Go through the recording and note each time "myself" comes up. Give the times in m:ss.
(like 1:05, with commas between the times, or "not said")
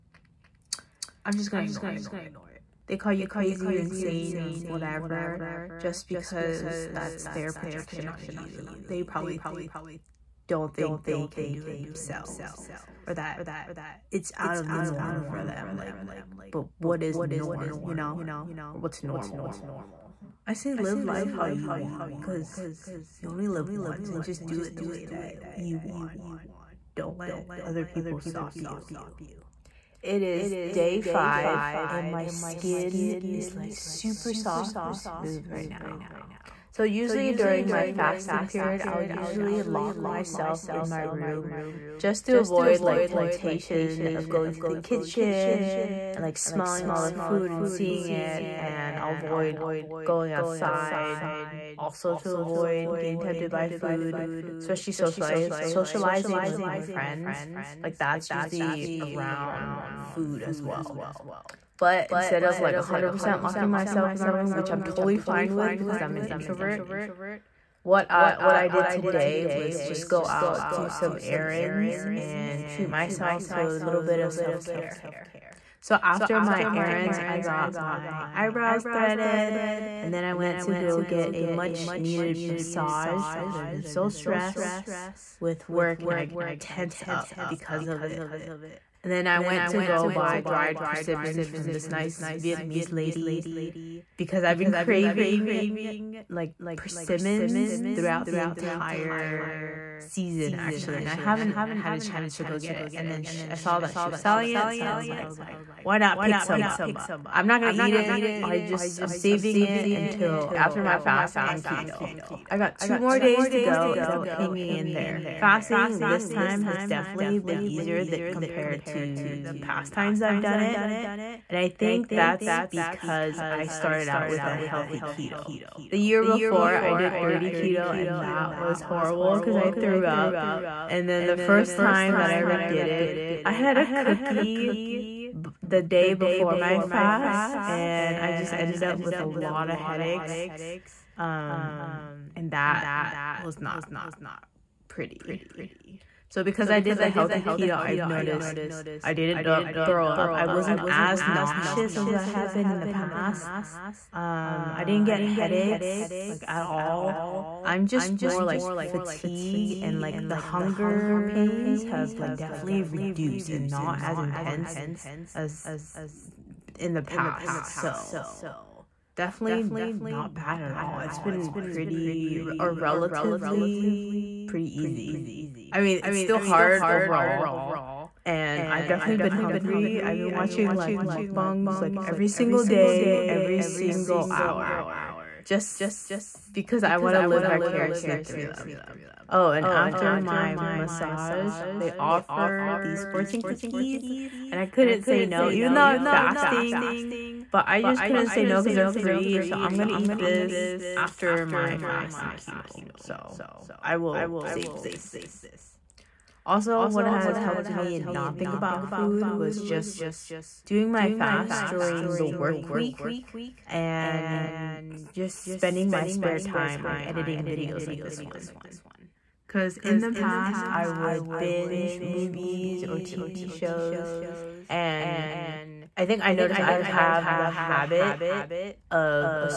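0:40, 1:03, 1:12.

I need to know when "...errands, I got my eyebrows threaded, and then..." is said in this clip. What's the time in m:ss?
1:16.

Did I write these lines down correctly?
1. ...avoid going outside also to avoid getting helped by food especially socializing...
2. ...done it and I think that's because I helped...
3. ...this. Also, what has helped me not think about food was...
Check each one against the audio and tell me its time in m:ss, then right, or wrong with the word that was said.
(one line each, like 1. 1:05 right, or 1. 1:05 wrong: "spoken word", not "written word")
1. 0:49 wrong: "tempted", not "helped"
2. 2:00 wrong: "started", not "helped"
3. 3:24 right.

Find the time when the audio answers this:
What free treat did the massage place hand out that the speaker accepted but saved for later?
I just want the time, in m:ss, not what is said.
3:13.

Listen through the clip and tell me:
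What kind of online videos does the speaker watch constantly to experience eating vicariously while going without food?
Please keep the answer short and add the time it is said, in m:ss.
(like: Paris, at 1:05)
mukbangs, at 3:01.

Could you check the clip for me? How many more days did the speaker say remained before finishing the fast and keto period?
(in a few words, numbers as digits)
2.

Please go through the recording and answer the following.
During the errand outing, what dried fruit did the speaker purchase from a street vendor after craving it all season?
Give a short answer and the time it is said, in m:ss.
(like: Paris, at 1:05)
dried persimmons, at 1:30.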